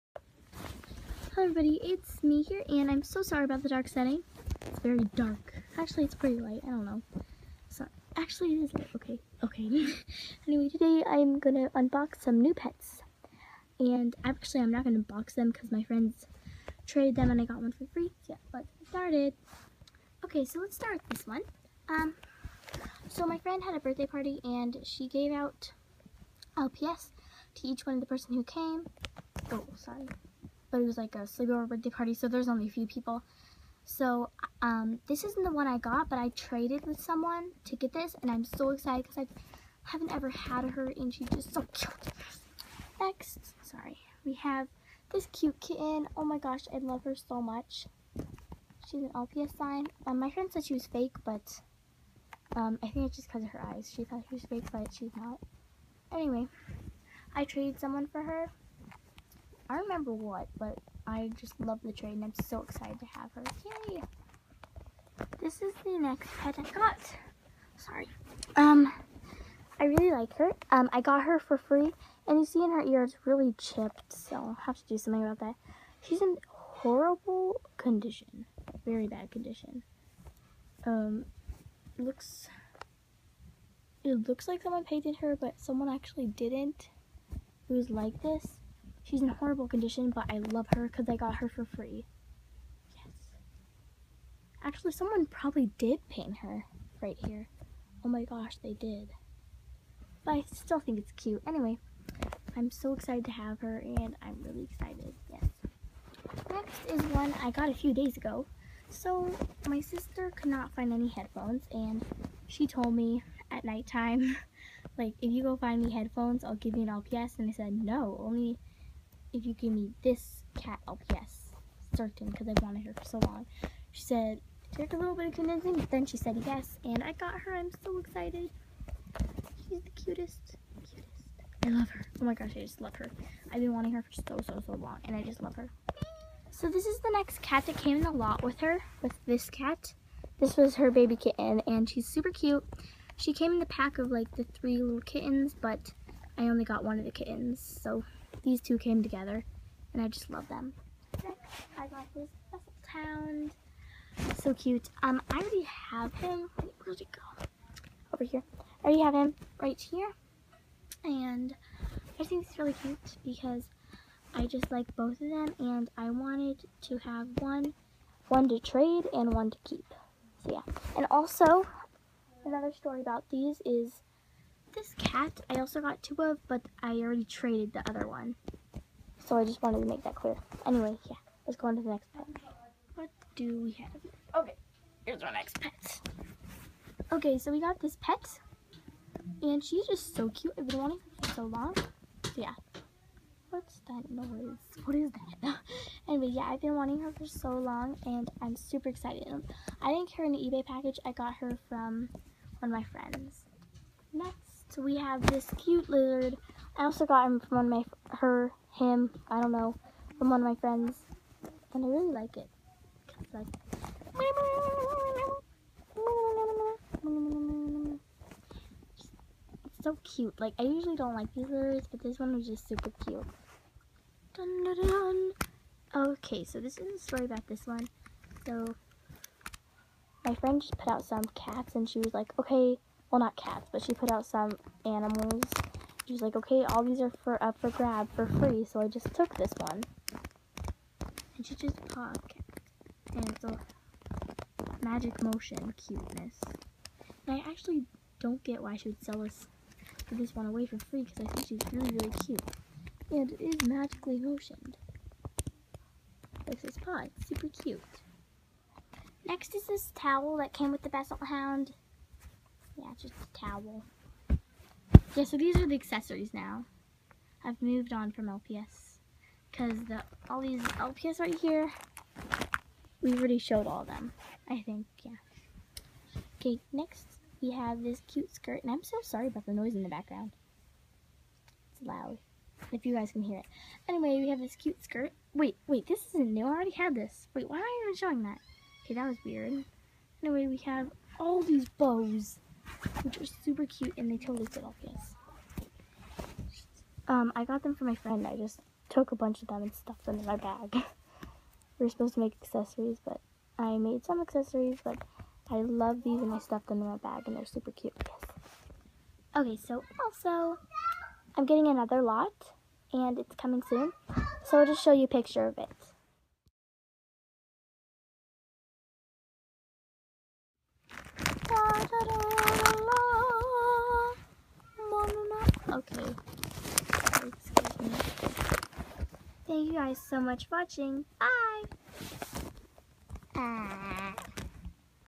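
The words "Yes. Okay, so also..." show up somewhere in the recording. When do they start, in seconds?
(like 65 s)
308 s.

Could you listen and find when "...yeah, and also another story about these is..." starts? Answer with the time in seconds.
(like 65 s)
170 s.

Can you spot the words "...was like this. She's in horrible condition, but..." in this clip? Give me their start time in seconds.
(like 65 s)
87 s.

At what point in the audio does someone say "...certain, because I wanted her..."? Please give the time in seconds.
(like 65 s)
121 s.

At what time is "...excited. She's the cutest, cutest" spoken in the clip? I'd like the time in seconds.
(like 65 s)
127 s.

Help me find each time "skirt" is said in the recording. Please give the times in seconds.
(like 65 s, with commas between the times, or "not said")
278 s, 284 s.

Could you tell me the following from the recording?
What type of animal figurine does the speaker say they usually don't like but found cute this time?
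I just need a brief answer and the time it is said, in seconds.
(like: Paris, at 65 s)
Lizard, at 205 s.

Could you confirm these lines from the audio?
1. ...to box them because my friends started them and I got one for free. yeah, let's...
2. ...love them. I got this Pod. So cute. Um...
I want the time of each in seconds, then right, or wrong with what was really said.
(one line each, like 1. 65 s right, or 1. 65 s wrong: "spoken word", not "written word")
1. 14 s wrong: "traded", not "started"
2. 150 s wrong: "Hound", not "Pod".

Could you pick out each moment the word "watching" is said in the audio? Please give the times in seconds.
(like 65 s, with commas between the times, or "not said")
330 s.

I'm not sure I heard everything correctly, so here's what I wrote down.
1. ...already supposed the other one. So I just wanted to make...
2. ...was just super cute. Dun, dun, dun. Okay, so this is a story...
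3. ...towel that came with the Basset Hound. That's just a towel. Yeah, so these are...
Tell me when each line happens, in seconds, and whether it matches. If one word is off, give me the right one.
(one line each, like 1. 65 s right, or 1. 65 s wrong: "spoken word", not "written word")
1. 176 s wrong: "traded", not "supposed"
2. 222 s right
3. 259 s right.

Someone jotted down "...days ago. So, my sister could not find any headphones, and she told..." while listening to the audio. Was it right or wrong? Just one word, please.
right.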